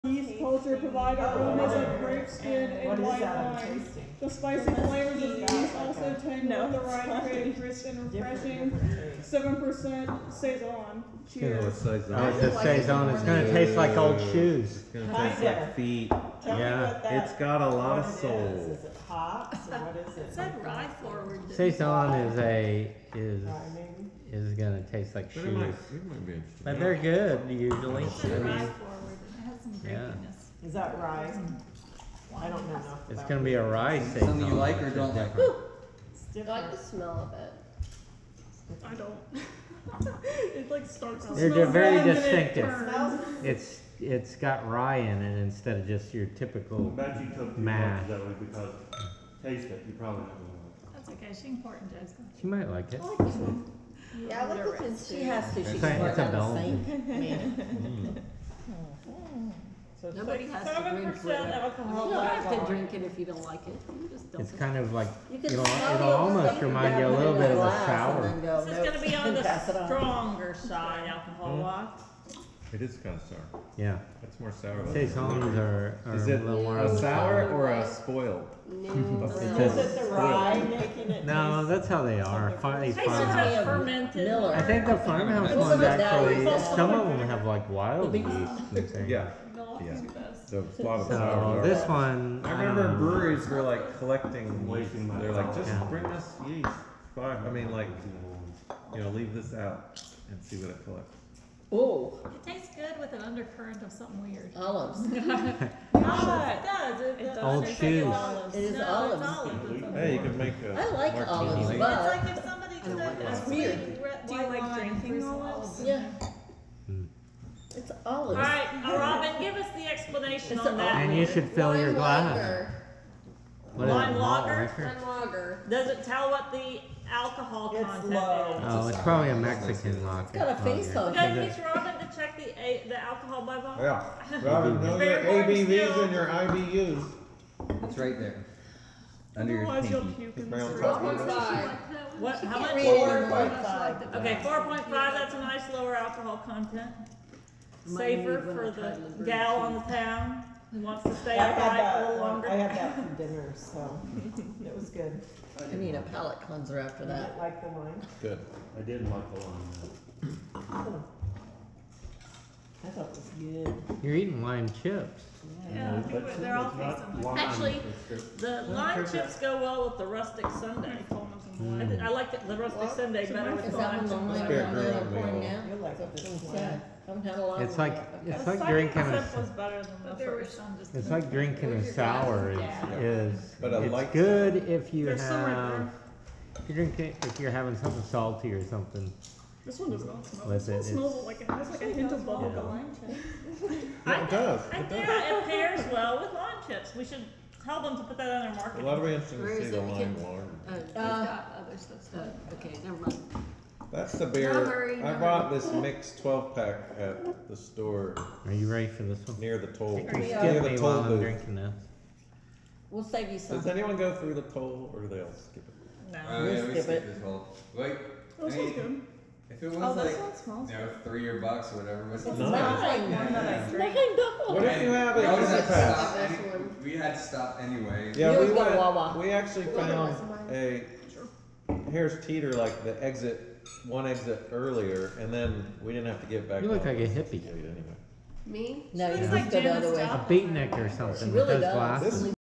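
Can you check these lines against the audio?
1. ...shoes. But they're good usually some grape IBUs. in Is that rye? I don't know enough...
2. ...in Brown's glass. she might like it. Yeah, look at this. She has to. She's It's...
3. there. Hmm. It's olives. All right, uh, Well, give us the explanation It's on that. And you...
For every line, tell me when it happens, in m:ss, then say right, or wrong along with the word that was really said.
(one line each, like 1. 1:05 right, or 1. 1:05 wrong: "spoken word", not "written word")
1. 0:25 wrong: "Yeah", not "IBUs"
2. 0:52 wrong: "Joe", not "Brown"
3. 1:56 wrong: "Robin", not "Well".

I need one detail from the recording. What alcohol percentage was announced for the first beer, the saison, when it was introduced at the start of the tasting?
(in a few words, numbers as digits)
7%.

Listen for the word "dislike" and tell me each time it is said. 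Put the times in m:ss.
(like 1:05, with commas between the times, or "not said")
not said.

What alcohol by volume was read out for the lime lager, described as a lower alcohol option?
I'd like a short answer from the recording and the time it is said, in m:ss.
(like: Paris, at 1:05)
4.5, at 2:24.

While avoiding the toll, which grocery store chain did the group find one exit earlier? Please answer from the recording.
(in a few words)
Harris Teeter.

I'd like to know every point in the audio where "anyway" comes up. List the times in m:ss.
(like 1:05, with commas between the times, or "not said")
3:47, 3:57.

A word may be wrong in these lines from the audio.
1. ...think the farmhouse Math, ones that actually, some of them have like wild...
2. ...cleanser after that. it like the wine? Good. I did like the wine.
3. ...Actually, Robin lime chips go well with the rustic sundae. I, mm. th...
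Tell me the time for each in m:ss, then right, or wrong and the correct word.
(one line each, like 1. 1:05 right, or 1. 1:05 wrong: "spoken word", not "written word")
1. 1:24 wrong: "Well", not "Math"
2. 2:36 right
3. 2:47 wrong: "The", not "Robin".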